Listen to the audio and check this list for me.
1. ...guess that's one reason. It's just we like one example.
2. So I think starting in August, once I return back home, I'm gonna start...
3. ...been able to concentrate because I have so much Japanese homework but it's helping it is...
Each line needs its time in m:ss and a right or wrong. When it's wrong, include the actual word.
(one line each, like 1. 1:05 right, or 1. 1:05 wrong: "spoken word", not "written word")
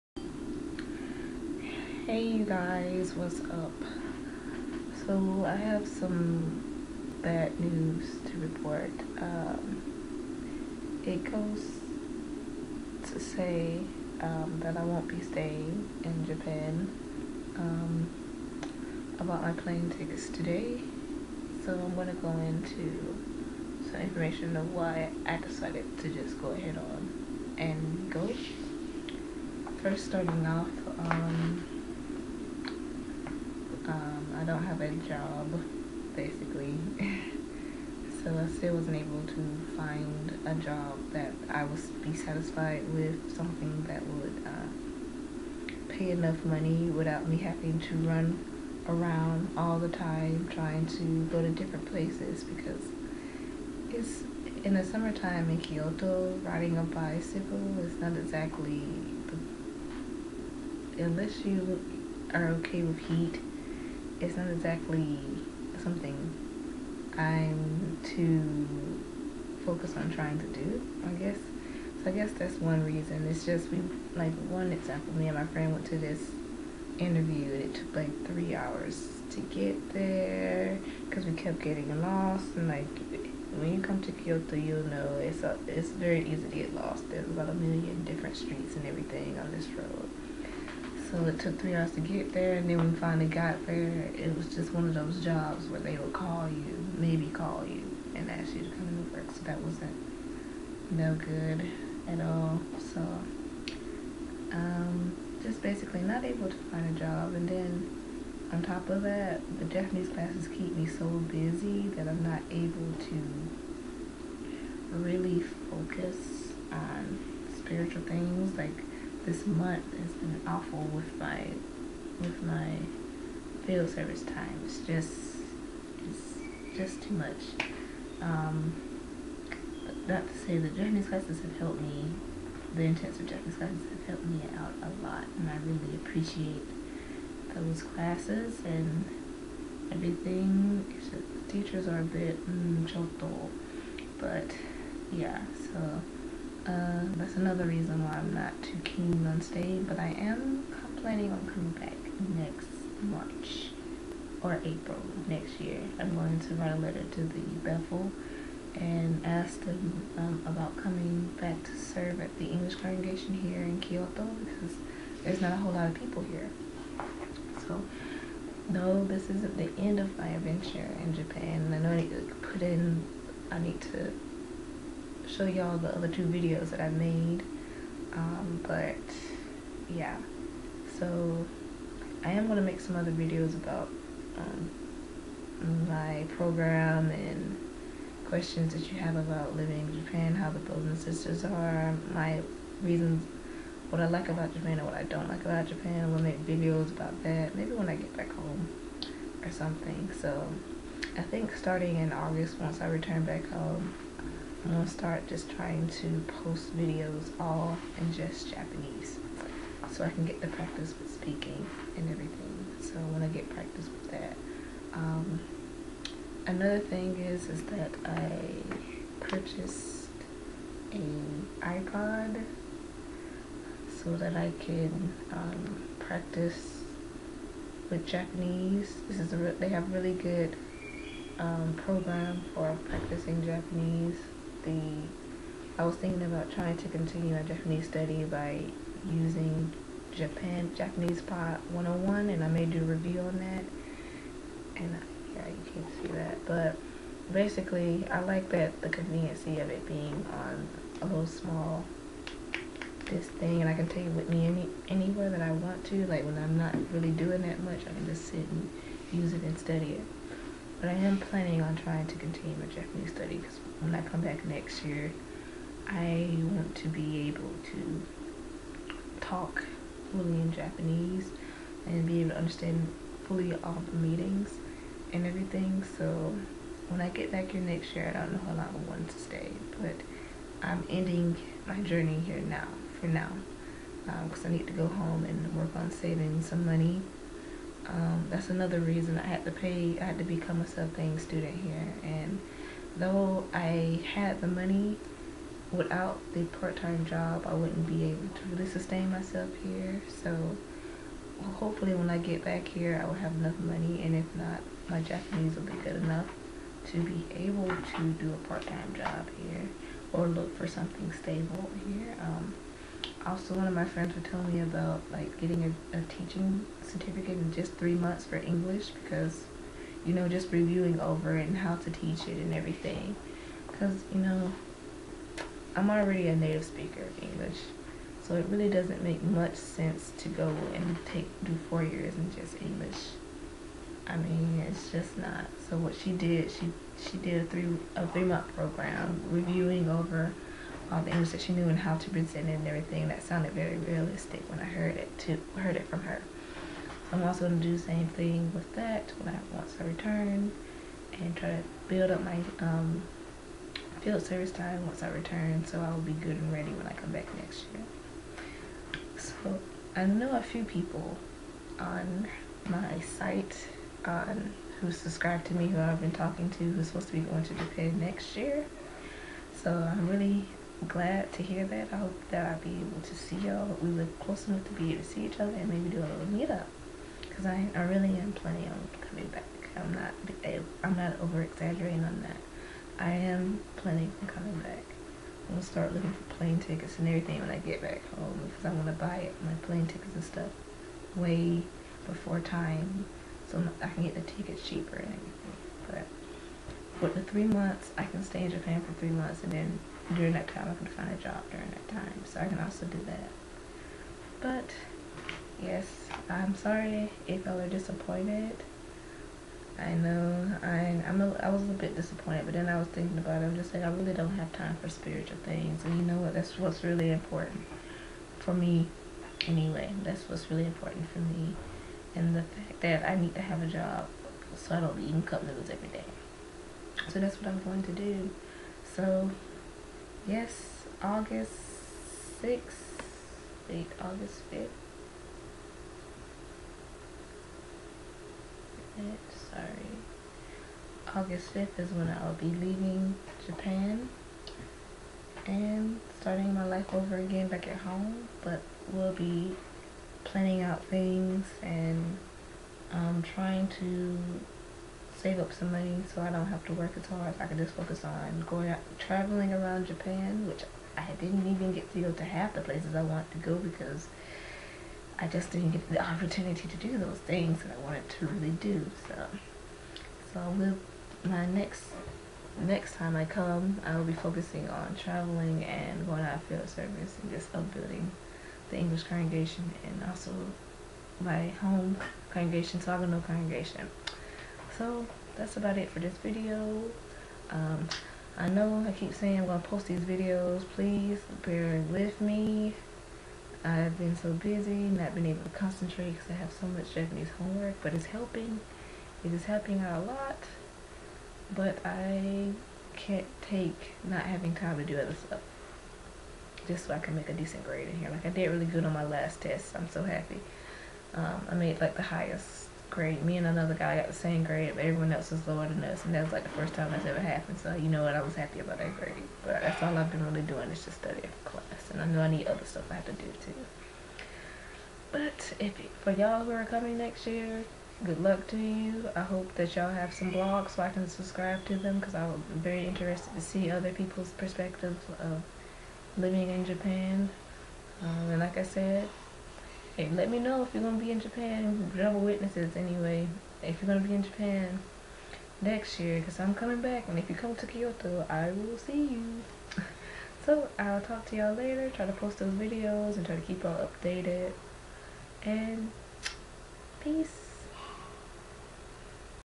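1. 1:12 right
2. 3:20 right
3. 8:15 right.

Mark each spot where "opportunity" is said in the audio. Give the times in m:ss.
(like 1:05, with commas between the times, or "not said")
7:46.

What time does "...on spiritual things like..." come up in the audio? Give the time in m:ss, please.
1:56.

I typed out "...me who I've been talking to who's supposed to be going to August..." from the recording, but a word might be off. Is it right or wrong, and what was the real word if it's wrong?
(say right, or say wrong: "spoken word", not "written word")
wrong: "Japan", not "August".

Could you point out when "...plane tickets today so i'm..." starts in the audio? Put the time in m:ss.
0:19.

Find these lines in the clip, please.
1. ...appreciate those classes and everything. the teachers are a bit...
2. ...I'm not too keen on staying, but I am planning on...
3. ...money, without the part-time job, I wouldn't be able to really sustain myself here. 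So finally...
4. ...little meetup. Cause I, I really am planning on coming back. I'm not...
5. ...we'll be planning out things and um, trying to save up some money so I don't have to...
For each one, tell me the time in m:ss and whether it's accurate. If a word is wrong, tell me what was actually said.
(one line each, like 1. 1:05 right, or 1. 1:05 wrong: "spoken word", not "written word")
1. 2:15 right
2. 2:28 right
3. 4:54 wrong: "hopefully", not "finally"
4. 6:16 right
5. 7:28 right.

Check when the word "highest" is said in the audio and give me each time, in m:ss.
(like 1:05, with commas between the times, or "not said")
8:32.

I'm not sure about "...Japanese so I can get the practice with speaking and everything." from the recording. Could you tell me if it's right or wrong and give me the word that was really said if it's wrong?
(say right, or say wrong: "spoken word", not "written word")
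right.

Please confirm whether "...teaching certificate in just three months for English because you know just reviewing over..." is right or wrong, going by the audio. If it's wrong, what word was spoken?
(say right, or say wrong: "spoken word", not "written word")
right.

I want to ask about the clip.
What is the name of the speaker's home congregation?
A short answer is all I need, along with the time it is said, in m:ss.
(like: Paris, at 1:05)
Saginaw congregation, at 8:02.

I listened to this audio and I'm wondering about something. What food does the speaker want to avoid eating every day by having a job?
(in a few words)
cup noodles.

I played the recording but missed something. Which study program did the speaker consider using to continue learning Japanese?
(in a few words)
JapanesePod101.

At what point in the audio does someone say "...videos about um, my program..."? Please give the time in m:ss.
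3:03.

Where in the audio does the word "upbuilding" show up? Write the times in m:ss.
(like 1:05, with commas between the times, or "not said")
7:57.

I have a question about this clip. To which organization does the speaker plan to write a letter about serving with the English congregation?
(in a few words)
Bethel.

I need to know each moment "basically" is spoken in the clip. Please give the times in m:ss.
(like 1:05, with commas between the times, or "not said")
0:36, 1:45, 4:07.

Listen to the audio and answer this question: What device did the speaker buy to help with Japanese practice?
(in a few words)
iPod.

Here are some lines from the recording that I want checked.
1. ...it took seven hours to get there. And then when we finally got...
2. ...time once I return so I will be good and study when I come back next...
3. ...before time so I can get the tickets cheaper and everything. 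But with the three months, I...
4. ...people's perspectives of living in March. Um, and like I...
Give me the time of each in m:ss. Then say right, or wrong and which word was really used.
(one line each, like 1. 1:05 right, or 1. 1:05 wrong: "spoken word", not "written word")
1. 1:31 wrong: "three", not "seven"
2. 5:54 wrong: "ready", not "study"
3. 6:32 right
4. 8:53 wrong: "Japan", not "March".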